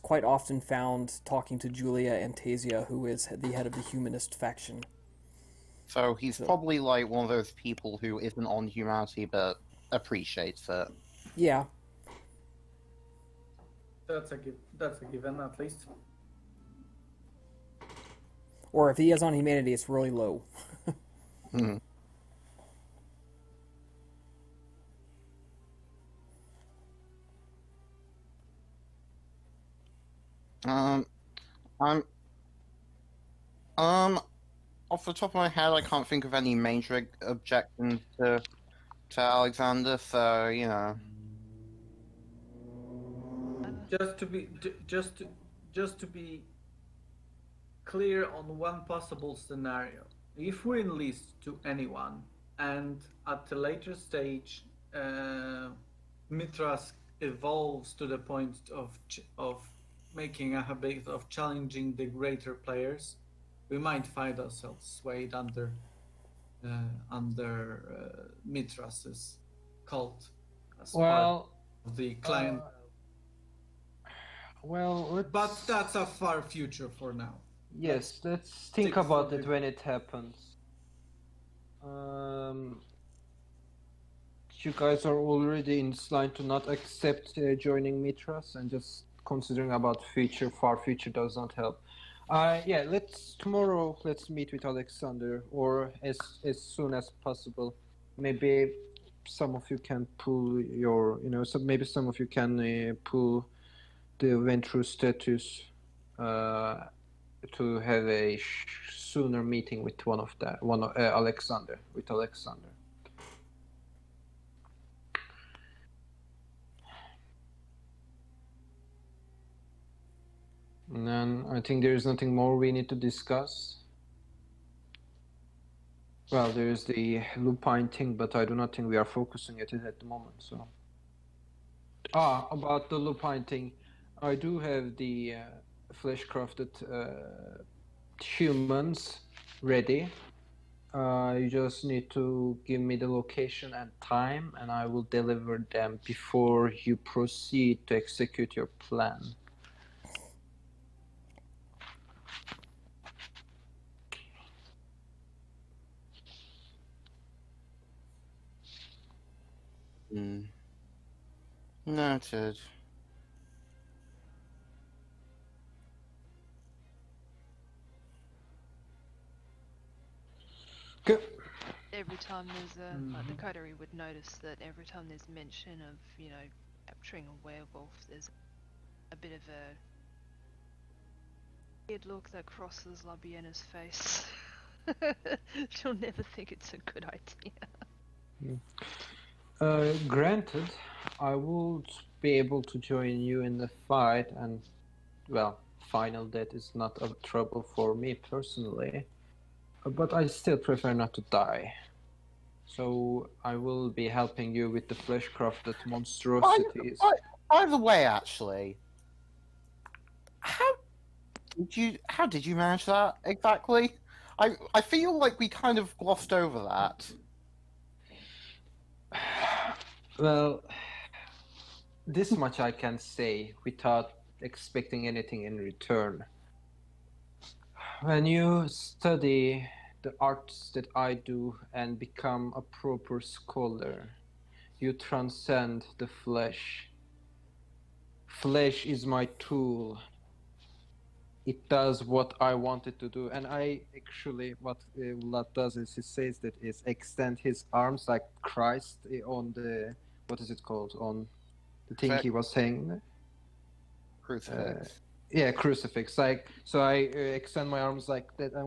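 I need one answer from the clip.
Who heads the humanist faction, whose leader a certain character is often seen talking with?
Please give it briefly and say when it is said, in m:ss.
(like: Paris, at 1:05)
Julia Antasia, at 0:01.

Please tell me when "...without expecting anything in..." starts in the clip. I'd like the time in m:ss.
3:43.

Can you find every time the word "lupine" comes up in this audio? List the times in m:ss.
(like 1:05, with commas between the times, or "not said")
2:07, 2:12.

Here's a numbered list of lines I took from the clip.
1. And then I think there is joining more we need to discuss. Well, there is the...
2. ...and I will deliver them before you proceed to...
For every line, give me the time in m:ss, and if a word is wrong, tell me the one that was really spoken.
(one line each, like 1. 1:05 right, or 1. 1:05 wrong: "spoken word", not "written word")
1. 2:00 wrong: "nothing", not "joining"
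2. 2:24 right.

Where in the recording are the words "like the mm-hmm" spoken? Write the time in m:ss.
2:53.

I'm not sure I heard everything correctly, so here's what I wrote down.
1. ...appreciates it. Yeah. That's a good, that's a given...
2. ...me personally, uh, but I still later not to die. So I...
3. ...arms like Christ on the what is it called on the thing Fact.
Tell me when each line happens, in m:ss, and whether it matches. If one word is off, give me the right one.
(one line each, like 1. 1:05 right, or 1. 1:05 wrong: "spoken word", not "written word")
1. 0:09 right
2. 3:17 wrong: "prefer", not "later"
3. 4:07 right.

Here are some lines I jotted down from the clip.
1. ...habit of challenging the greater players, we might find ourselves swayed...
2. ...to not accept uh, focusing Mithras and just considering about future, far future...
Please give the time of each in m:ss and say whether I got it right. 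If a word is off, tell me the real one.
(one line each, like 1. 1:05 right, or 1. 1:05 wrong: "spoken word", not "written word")
1. 1:00 right
2. 1:26 wrong: "joining", not "focusing".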